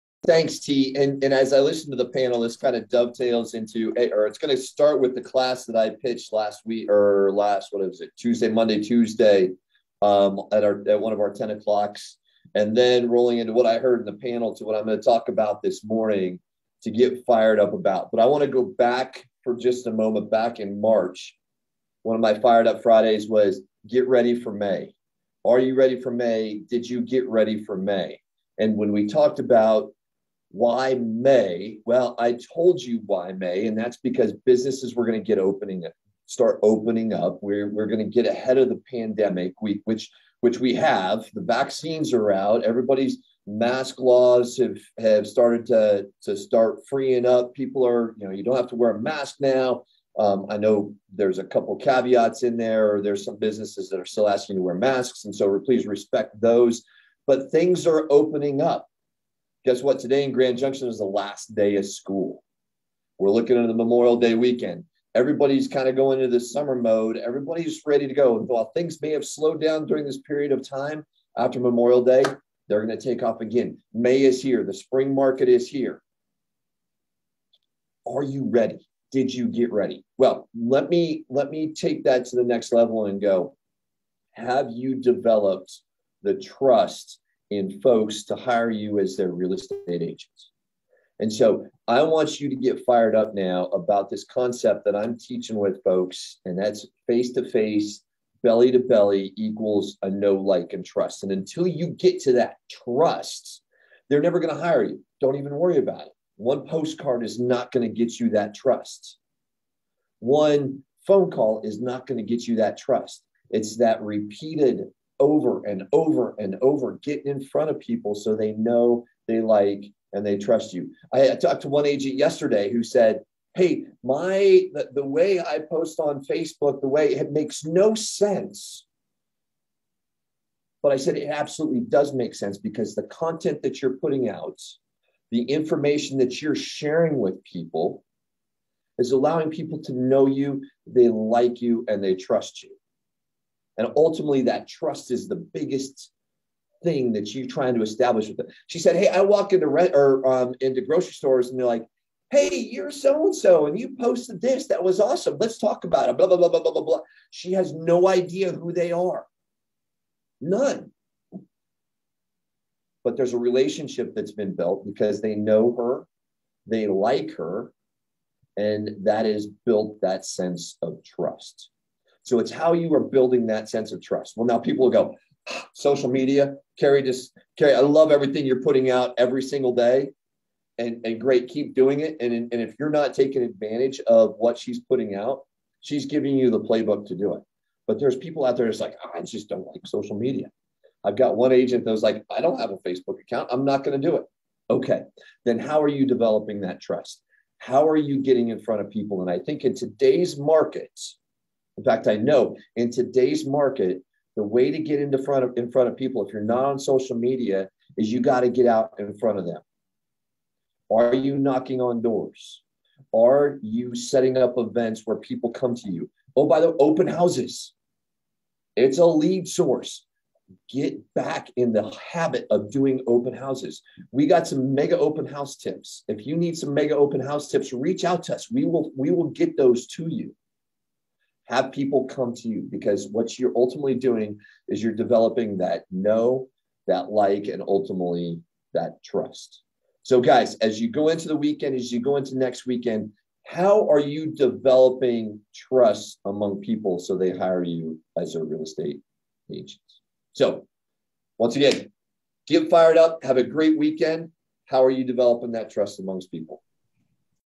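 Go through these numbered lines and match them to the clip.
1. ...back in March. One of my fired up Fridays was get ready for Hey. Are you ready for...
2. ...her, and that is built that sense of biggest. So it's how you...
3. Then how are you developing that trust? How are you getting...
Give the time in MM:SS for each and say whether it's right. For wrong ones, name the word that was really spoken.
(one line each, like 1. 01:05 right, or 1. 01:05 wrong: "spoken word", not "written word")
1. 00:20 wrong: "May", not "Hey"
2. 02:47 wrong: "trust", not "biggest"
3. 03:15 right.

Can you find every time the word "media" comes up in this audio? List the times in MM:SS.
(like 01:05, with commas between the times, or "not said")
02:56, 03:10, 03:27.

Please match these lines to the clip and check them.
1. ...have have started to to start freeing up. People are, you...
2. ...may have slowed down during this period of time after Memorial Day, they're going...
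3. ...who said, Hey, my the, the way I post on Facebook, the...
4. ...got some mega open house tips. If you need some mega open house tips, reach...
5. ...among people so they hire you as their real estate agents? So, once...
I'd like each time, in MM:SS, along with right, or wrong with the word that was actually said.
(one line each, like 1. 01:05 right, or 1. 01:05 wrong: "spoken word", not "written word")
1. 00:44 right
2. 01:09 right
3. 02:02 right
4. 03:44 right
5. 04:06 right.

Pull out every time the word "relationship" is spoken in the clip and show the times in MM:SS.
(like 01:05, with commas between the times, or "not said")
02:43.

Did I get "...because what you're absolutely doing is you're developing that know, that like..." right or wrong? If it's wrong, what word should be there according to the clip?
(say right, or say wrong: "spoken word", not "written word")
wrong: "ultimately", not "absolutely".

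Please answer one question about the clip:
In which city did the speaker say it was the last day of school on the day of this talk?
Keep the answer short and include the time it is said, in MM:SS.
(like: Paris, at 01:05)
Grand Junction, at 01:00.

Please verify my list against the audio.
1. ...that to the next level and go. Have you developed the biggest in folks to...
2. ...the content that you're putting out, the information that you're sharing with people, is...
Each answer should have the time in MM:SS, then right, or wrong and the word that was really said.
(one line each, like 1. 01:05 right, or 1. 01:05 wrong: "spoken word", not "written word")
1. 01:22 wrong: "trust", not "biggest"
2. 02:12 right.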